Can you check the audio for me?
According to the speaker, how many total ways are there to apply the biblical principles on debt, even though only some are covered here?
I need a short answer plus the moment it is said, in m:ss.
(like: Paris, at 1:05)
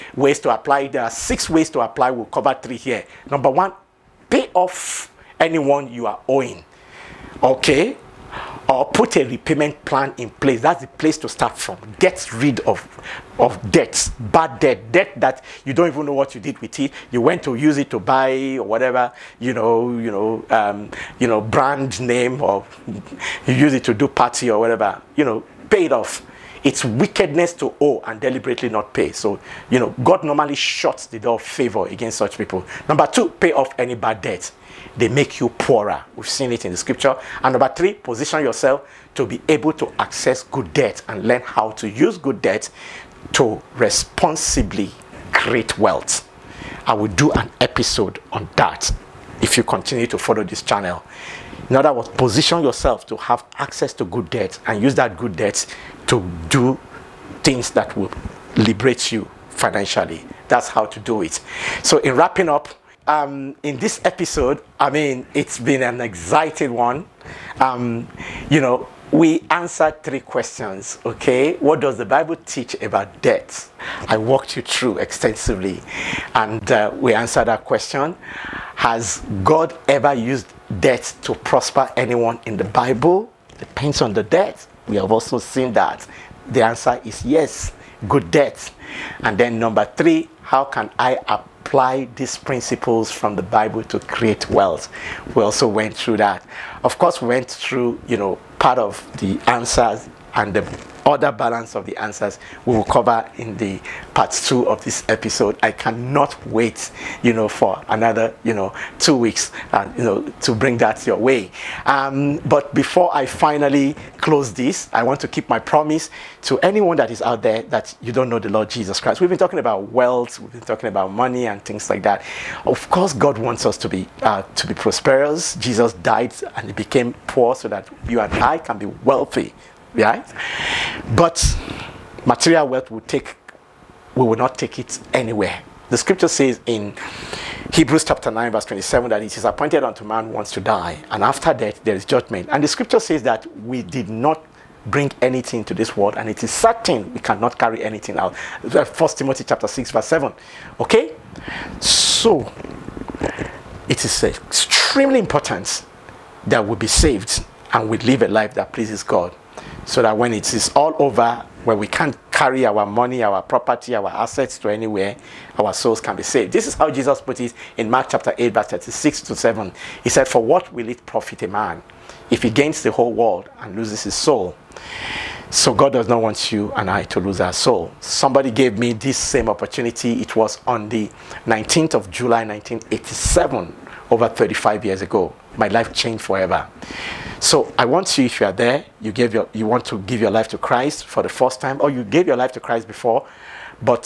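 6, at 0:01.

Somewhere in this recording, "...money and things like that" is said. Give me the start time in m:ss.
2:01.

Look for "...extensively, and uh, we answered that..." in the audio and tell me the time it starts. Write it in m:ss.
1:14.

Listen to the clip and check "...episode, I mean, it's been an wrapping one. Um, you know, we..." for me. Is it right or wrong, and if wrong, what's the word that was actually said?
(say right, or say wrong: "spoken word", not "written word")
wrong: "exciting", not "wrapping".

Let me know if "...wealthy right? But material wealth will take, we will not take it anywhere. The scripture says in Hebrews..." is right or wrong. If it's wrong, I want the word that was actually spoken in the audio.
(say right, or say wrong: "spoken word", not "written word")
right.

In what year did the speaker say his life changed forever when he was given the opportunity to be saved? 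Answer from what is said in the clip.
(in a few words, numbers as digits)
1987.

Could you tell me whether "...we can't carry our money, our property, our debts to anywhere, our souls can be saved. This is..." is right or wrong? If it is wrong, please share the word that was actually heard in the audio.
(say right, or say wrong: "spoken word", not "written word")
wrong: "assets", not "debts".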